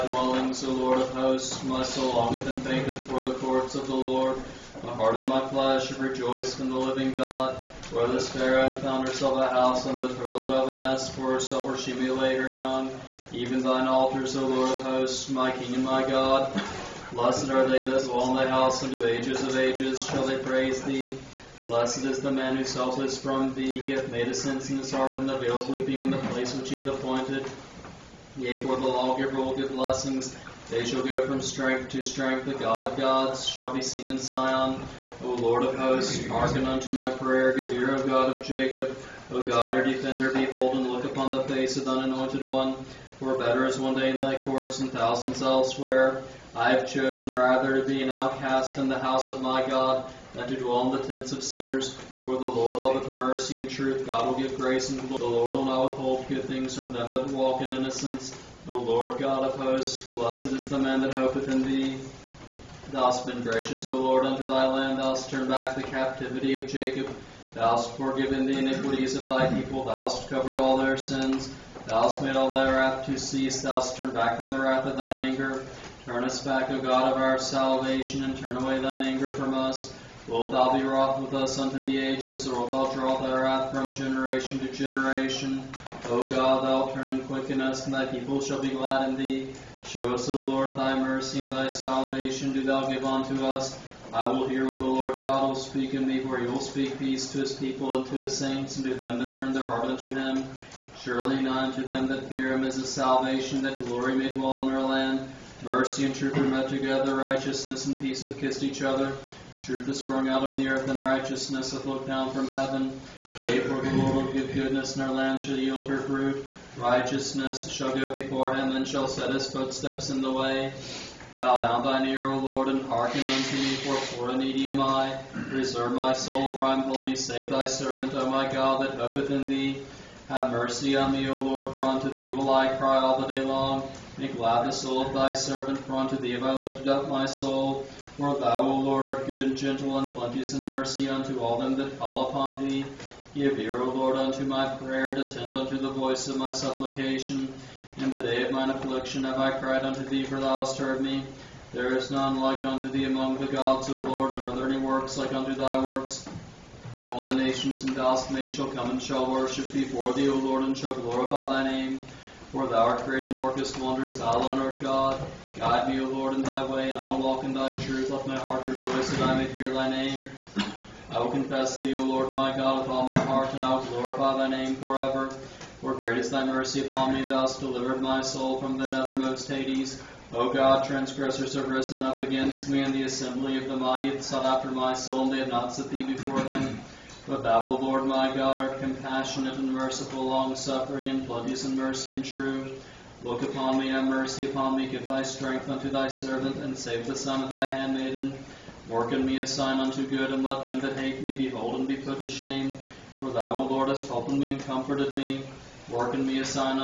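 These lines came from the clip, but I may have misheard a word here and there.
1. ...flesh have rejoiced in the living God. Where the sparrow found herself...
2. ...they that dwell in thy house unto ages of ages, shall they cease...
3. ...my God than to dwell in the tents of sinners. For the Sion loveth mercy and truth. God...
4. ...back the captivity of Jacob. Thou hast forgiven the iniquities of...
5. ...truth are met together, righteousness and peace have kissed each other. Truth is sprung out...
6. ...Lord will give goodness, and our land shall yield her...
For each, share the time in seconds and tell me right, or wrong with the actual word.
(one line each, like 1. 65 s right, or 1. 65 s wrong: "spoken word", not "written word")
1. 5 s right
2. 17 s wrong: "praise", not "cease"
3. 49 s wrong: "Lord", not "Sion"
4. 65 s right
5. 106 s right
6. 113 s right.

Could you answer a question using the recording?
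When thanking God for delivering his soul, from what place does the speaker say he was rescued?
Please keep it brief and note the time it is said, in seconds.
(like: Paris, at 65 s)
The nethermost Hades, at 178 s.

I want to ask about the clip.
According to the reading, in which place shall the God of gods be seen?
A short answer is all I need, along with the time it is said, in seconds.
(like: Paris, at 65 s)
Sion, at 34 s.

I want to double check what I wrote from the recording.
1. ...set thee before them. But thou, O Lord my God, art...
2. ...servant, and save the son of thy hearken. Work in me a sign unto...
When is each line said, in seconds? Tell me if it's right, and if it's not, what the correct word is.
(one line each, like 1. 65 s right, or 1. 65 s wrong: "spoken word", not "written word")
1. 185 s right
2. 196 s wrong: "handmaiden", not "hearken".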